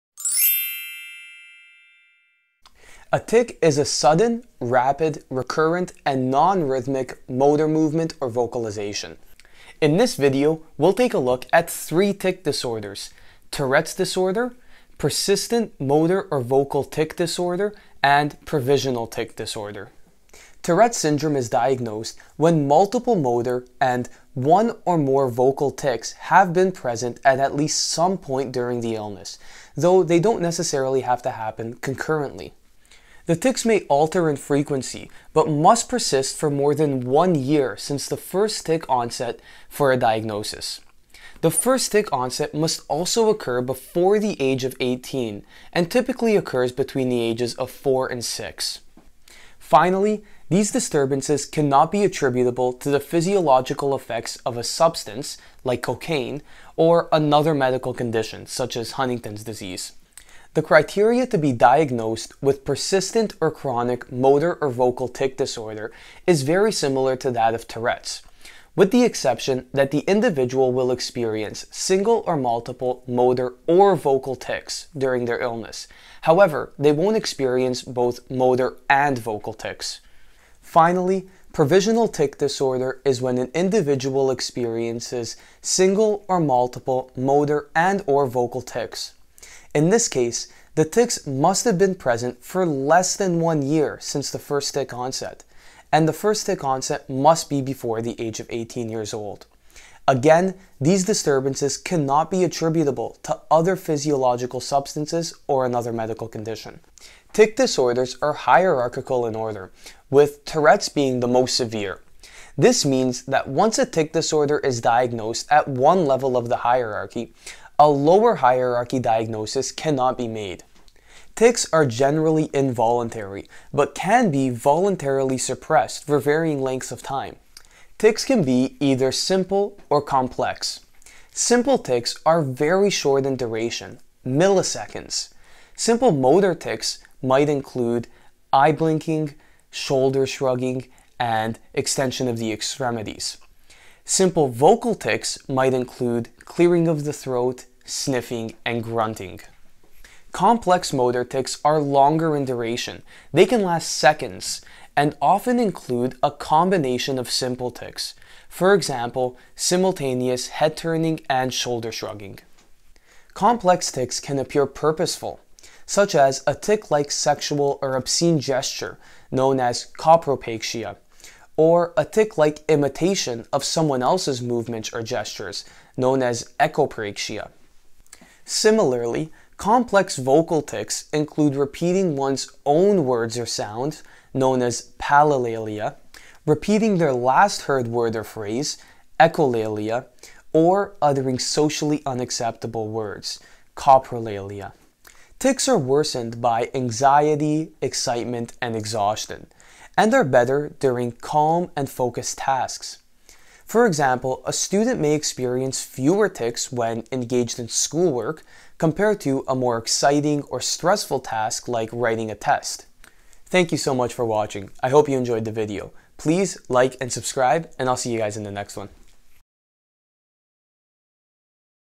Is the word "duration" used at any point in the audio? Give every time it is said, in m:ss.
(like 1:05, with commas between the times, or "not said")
2:13, 2:32.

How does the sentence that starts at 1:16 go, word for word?
However, they won't experience both motor and vocal tics.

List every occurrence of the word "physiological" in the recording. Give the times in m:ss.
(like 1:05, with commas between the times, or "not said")
0:52, 1:43.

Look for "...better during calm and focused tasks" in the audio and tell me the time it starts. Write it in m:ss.
3:20.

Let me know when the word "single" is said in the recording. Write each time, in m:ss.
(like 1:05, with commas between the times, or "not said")
1:11, 1:25.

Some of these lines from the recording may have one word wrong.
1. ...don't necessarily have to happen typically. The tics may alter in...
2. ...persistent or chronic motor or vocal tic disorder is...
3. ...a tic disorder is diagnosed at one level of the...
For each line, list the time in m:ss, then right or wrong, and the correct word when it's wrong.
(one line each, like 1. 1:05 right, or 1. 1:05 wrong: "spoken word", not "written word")
1. 0:30 wrong: "concurrently", not "typically"
2. 1:02 right
3. 1:53 right.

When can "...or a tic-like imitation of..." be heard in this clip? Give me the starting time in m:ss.
2:51.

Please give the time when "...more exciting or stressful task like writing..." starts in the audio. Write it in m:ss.
3:29.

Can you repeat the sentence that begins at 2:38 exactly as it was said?
For example, simultaneous head turning and shoulder shrugging.